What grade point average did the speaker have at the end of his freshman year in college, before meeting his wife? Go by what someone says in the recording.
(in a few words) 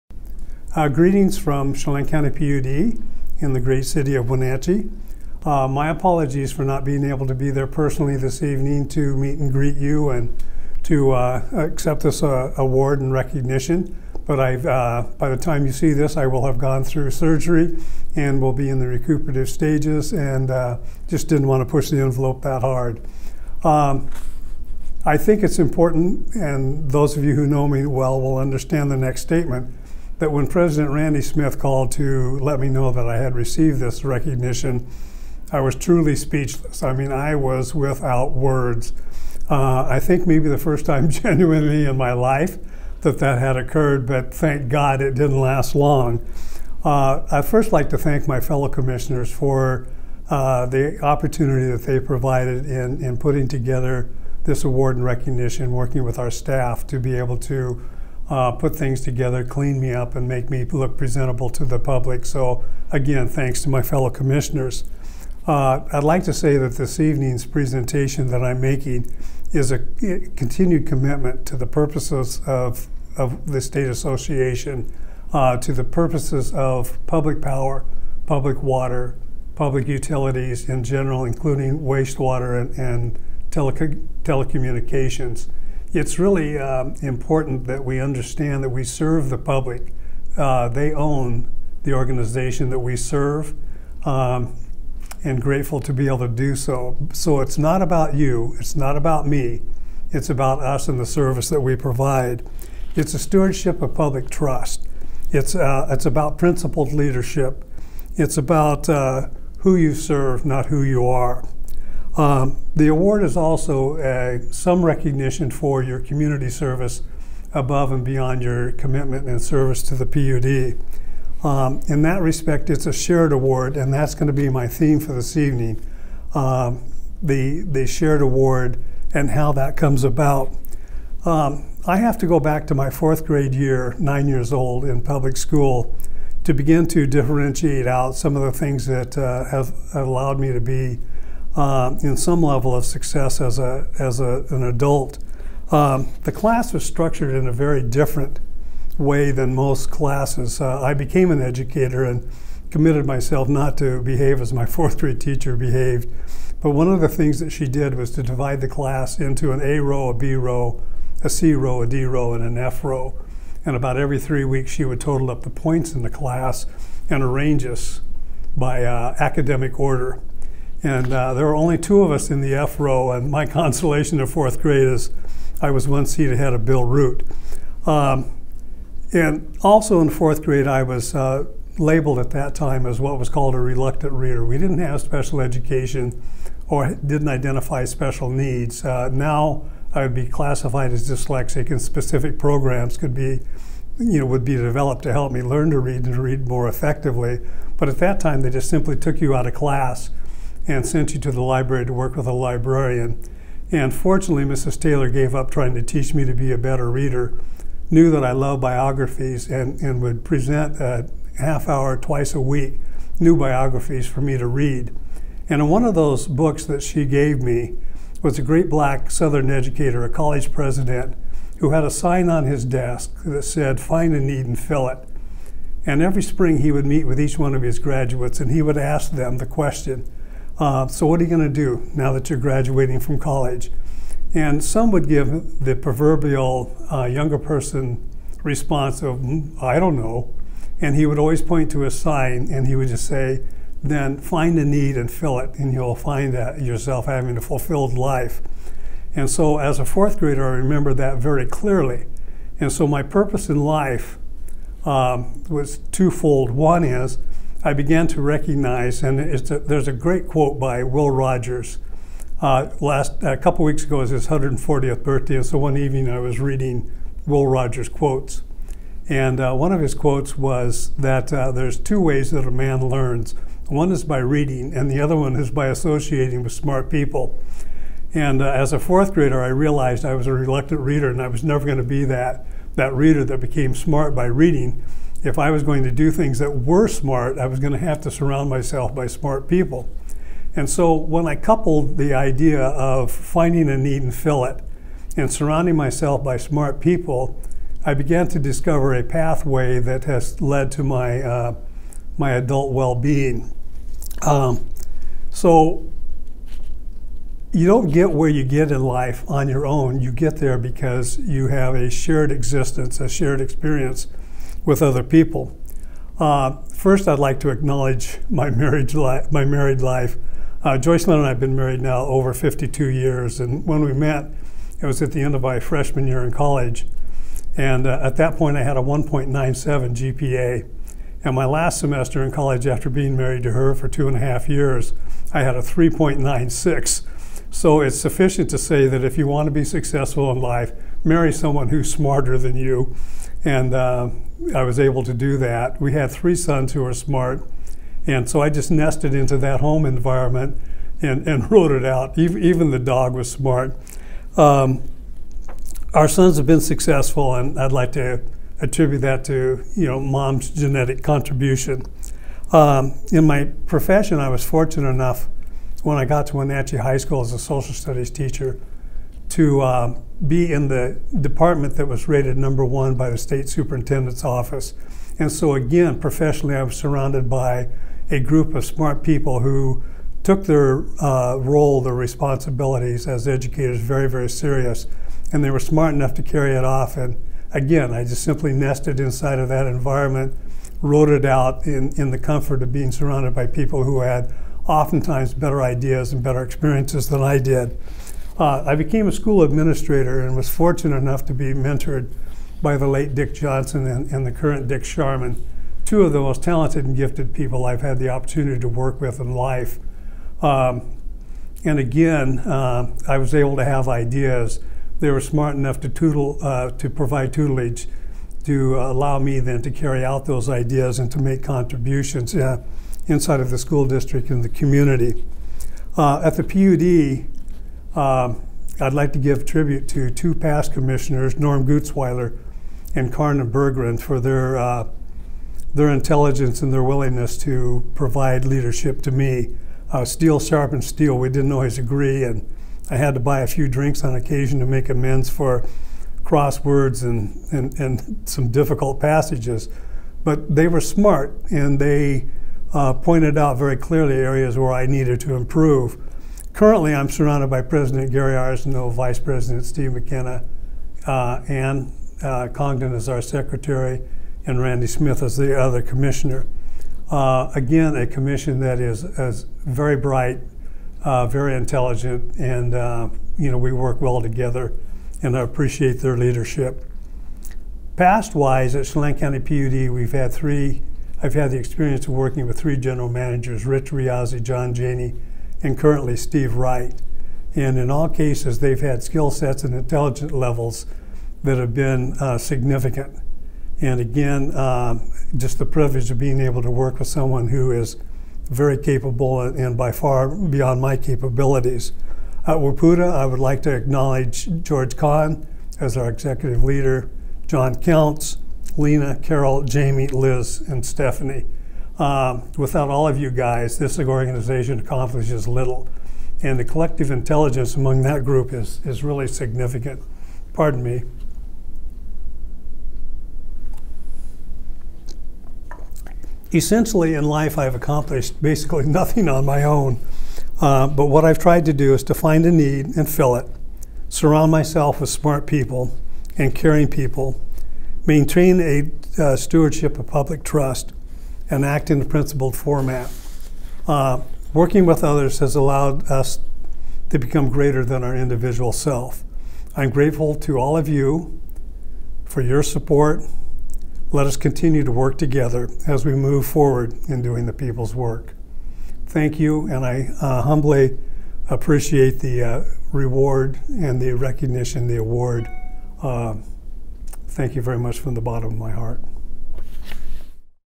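1.97.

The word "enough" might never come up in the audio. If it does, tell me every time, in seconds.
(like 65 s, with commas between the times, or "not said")
364 s, 385 s, 400 s, 415 s.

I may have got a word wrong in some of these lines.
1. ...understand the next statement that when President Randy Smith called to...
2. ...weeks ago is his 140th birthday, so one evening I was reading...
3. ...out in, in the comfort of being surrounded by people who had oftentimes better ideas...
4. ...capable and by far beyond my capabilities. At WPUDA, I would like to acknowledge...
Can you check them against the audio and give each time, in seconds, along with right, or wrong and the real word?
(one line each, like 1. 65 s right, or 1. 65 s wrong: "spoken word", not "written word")
1. 28 s right
2. 263 s right
3. 391 s right
4. 498 s right.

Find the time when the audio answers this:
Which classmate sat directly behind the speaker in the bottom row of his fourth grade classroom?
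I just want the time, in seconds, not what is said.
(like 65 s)
176 s.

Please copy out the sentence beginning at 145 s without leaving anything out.
Um, the class was structured in a very different way than most classes.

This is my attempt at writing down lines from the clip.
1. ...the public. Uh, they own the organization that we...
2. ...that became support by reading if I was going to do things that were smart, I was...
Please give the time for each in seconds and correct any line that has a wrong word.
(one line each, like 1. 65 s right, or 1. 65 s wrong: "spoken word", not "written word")
1. 89 s right
2. 283 s wrong: "smart", not "support".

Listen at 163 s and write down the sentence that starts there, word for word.
And about every three weeks, she would total up the points in the class and arrange us by uh, academic order.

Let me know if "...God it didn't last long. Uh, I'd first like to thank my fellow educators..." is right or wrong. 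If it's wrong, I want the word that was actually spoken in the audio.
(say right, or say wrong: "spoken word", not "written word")
wrong: "commissioners", not "educators".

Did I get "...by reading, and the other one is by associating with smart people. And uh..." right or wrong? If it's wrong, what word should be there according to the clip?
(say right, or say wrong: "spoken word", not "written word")
right.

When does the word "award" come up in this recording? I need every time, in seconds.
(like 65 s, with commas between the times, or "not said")
12 s, 54 s, 112 s, 123 s, 128 s, 564 s.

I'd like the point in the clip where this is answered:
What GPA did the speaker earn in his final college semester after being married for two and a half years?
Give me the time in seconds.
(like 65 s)
335 s.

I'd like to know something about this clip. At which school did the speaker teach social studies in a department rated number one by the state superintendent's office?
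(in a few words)
Wenatchee High School.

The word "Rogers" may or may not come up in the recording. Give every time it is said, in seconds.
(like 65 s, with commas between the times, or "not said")
261 s, 267 s.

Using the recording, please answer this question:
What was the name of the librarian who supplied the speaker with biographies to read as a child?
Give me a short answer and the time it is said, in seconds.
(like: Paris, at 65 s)
Mrs. Taylor, at 204 s.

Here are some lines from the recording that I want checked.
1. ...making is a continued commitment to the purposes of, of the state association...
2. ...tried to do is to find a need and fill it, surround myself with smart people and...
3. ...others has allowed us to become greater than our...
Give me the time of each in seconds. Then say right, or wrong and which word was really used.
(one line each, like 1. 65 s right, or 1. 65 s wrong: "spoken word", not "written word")
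1. 68 s right
2. 531 s right
3. 545 s right.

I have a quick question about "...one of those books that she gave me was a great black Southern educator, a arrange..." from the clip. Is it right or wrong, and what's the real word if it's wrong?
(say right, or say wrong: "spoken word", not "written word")
wrong: "college", not "arrange".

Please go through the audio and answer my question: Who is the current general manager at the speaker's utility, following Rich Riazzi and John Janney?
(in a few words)
Steve Wright.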